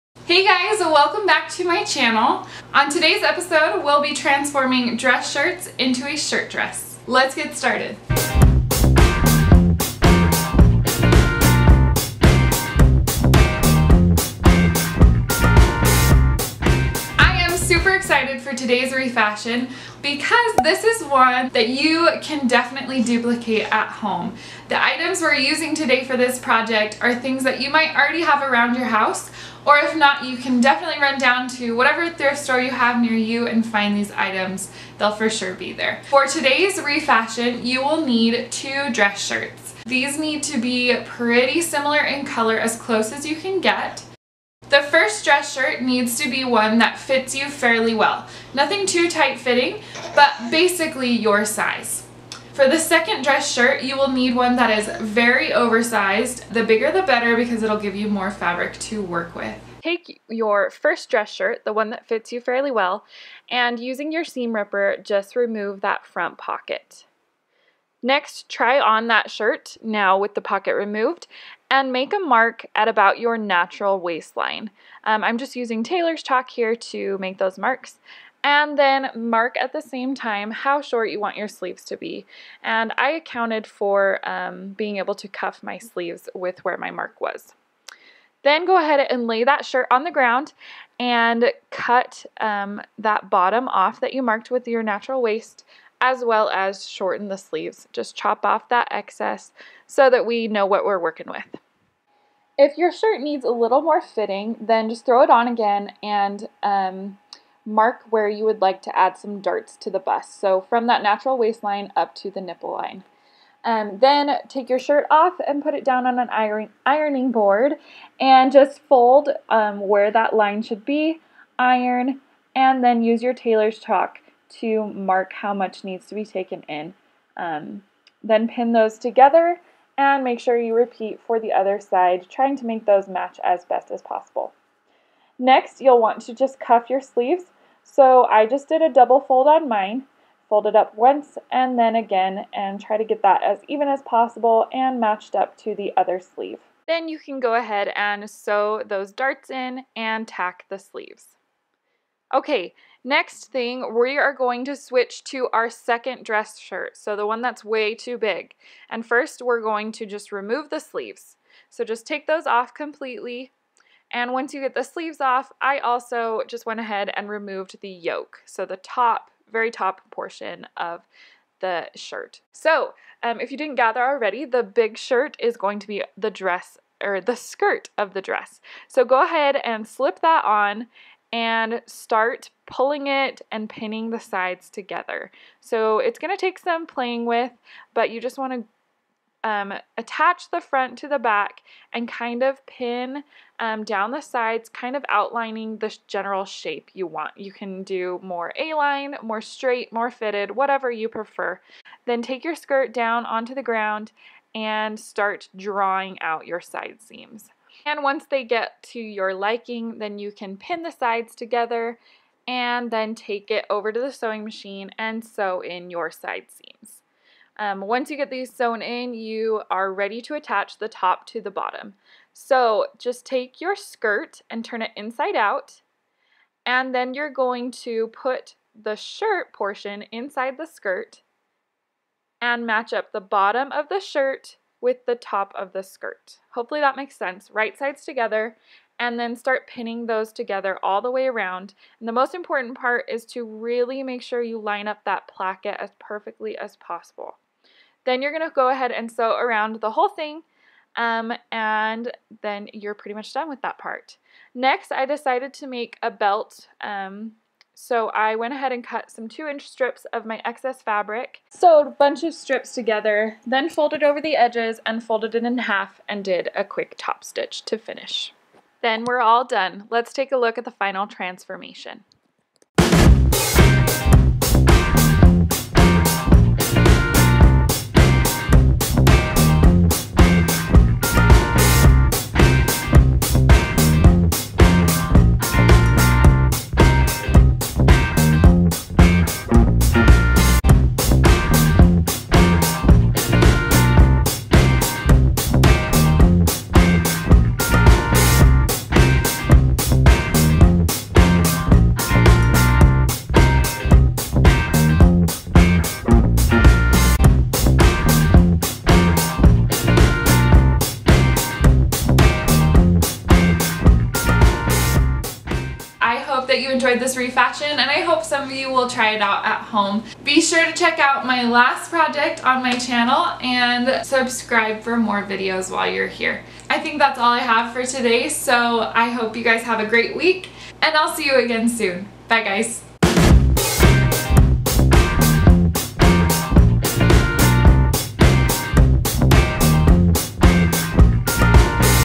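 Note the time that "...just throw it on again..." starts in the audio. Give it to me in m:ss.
1:44.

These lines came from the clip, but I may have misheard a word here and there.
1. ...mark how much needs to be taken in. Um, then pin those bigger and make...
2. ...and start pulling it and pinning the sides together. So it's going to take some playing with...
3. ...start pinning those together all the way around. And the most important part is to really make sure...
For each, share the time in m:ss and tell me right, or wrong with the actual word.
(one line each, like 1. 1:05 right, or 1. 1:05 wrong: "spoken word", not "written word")
1. 2:04 wrong: "together", not "bigger"
2. 3:01 right
3. 3:59 right.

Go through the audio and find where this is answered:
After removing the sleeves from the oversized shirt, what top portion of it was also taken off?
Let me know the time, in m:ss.
2:47.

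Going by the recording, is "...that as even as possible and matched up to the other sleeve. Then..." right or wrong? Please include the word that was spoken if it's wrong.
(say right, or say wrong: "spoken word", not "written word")
right.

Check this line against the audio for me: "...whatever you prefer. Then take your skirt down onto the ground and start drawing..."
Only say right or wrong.
right.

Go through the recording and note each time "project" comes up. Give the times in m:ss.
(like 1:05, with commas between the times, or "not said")
0:26, 5:21.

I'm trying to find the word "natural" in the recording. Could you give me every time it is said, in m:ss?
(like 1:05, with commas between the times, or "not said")
1:13, 1:34, 1:51.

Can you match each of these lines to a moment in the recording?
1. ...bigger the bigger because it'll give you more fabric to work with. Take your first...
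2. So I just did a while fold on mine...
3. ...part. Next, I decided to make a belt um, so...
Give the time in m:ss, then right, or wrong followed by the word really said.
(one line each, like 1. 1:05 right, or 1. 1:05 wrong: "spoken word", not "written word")
1. 0:56 wrong: "better", not "bigger"
2. 2:17 wrong: "double", not "while"
3. 4:13 right.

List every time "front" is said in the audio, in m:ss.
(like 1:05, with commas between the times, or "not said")
1:06, 3:10.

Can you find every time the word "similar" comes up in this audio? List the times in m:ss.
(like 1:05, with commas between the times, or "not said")
0:41.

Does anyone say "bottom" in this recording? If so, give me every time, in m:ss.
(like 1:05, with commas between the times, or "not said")
1:33, 3:41, 3:53.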